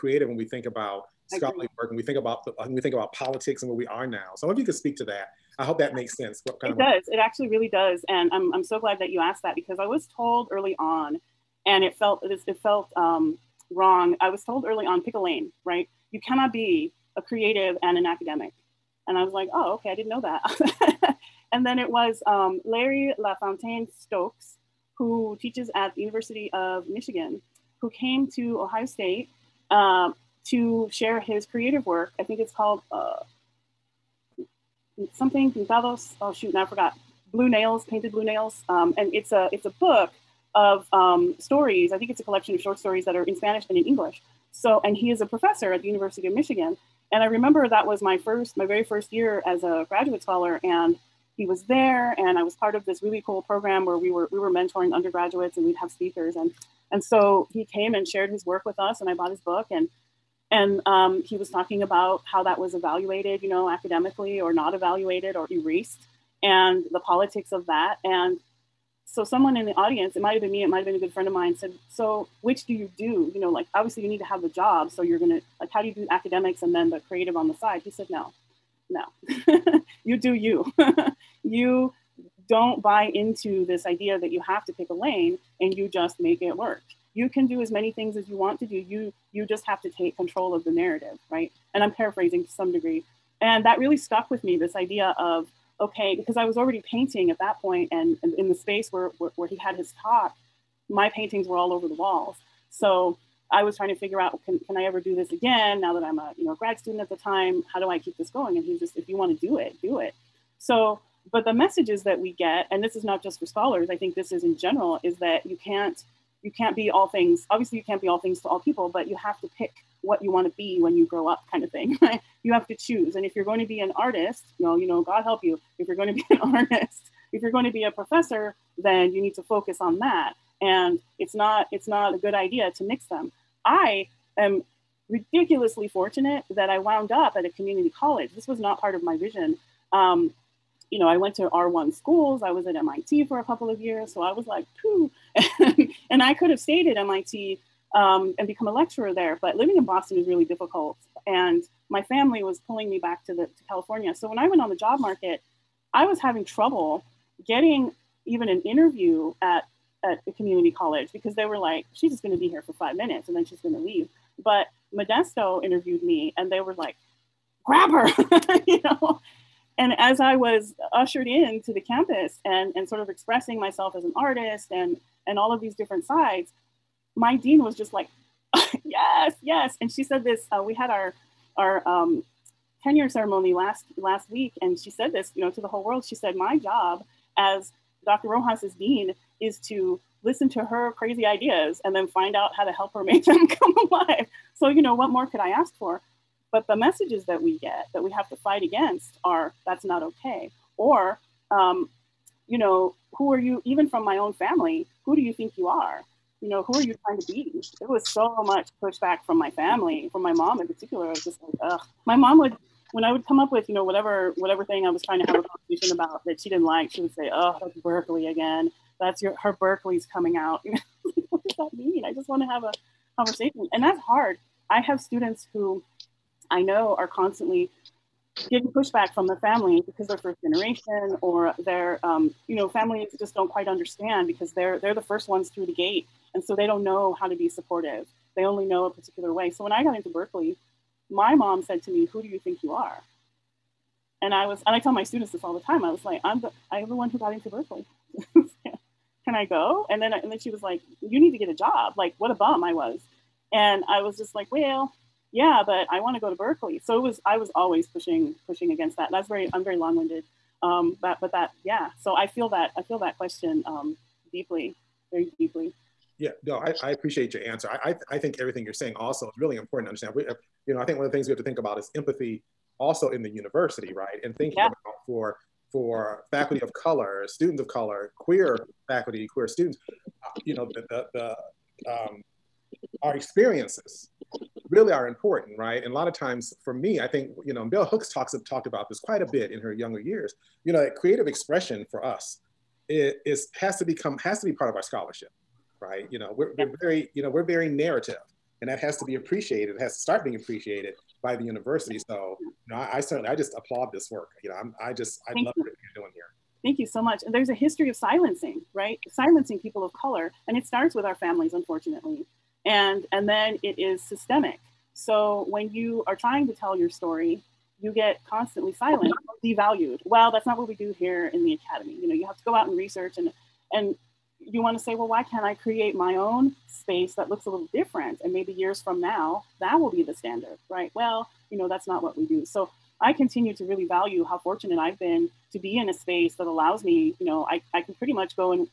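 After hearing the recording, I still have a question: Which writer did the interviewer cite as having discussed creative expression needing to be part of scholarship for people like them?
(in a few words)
bell hooks.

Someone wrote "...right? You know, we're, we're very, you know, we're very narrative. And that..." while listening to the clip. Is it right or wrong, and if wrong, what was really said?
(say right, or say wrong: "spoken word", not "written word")
right.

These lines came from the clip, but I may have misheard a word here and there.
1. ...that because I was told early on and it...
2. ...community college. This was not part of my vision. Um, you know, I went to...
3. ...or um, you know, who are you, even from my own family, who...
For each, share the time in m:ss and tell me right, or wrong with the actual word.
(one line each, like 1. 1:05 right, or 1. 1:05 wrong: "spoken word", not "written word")
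1. 0:09 right
2. 2:17 right
3. 3:20 right.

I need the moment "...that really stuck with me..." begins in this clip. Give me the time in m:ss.
1:33.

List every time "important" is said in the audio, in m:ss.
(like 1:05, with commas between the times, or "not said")
4:29, 4:45.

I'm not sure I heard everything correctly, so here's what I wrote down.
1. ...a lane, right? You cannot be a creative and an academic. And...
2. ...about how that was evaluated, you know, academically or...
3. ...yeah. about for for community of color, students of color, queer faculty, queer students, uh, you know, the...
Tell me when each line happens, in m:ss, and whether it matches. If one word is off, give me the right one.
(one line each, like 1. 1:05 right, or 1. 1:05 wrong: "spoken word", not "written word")
1. 0:15 right
2. 1:01 right
3. 4:34 wrong: "faculty", not "community".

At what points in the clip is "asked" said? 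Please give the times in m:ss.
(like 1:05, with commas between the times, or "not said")
0:09.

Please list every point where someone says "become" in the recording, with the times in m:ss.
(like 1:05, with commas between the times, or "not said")
2:28, 4:53.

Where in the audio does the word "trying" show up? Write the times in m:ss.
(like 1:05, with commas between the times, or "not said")
1:43, 3:27, 3:35, 5:16.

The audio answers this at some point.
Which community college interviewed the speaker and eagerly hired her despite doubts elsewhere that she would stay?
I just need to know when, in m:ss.
2:44.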